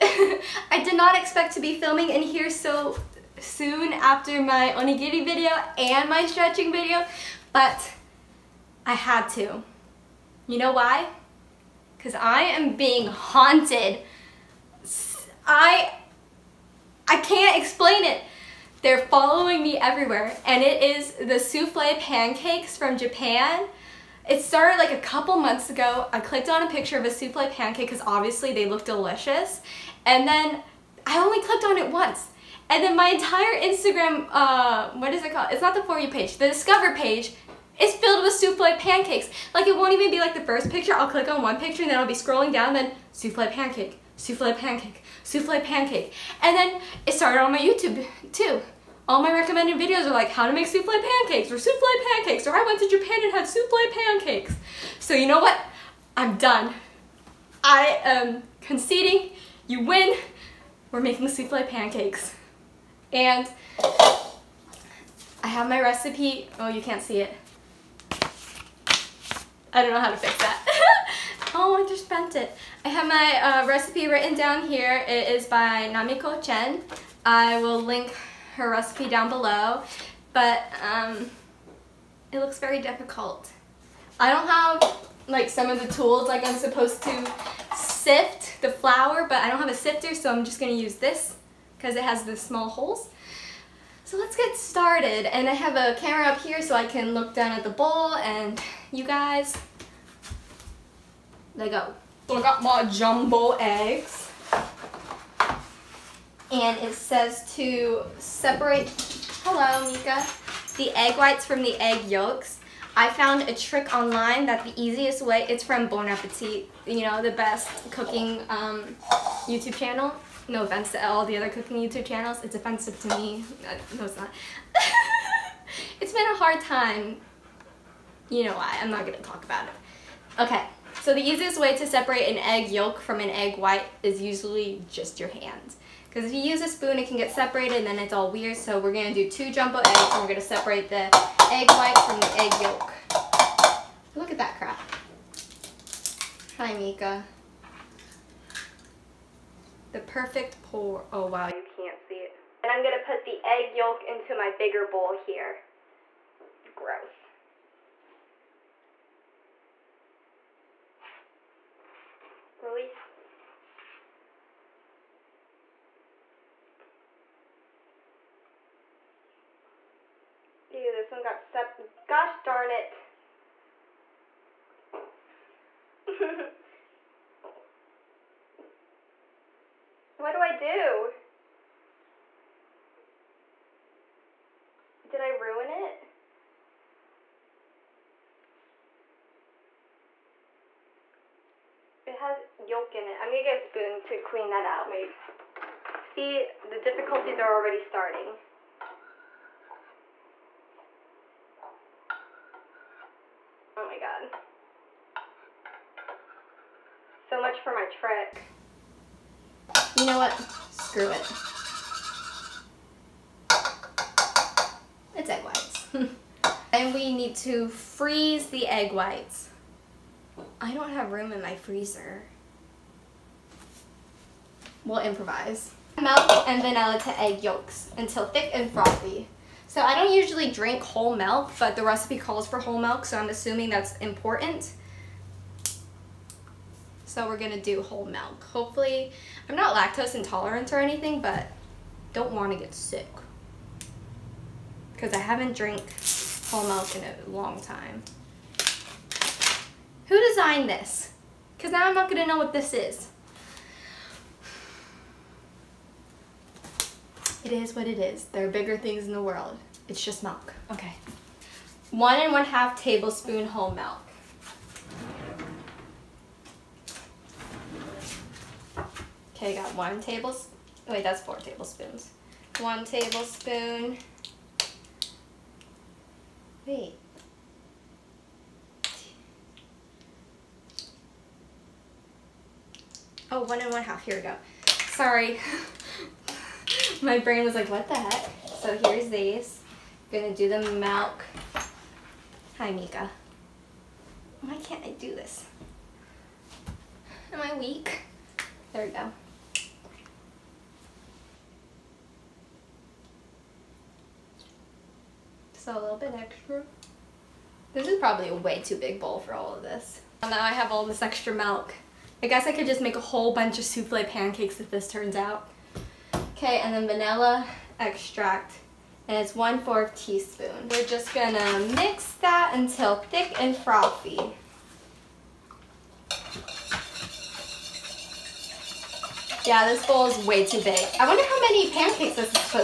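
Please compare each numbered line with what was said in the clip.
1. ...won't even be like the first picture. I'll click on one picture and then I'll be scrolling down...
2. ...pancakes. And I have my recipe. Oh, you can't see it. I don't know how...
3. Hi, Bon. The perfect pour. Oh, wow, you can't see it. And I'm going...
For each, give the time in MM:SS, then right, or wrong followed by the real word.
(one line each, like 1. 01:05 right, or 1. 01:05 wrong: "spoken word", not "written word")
1. 00:39 right
2. 01:01 right
3. 02:26 wrong: "Mika", not "Bon".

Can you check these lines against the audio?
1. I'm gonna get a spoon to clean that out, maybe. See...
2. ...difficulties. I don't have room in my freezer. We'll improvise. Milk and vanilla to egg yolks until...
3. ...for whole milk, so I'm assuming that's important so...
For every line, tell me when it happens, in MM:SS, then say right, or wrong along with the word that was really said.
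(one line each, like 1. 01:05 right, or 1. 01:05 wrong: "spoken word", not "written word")
1. 03:13 right
2. 03:38 wrong: "whites", not "difficulties"
3. 03:52 right.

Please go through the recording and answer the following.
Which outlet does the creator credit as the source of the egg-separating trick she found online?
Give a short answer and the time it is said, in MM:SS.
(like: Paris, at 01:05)
Bon Appetit, at 01:55.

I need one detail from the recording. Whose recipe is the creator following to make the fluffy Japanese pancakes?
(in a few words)
Namiko Chen.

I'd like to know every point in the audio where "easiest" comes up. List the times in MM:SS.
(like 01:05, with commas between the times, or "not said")
01:54, 02:11.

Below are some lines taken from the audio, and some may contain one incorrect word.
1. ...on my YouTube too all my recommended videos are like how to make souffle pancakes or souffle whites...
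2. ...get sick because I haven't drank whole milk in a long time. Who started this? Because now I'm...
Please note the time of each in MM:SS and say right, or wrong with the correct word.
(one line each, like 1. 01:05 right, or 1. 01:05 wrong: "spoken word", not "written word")
1. 00:47 wrong: "pancakes", not "whites"
2. 04:02 wrong: "designed", not "started".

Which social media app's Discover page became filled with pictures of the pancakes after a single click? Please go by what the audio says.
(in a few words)
Instagram.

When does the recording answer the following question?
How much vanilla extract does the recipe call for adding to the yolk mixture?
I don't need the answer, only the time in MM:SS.
05:19.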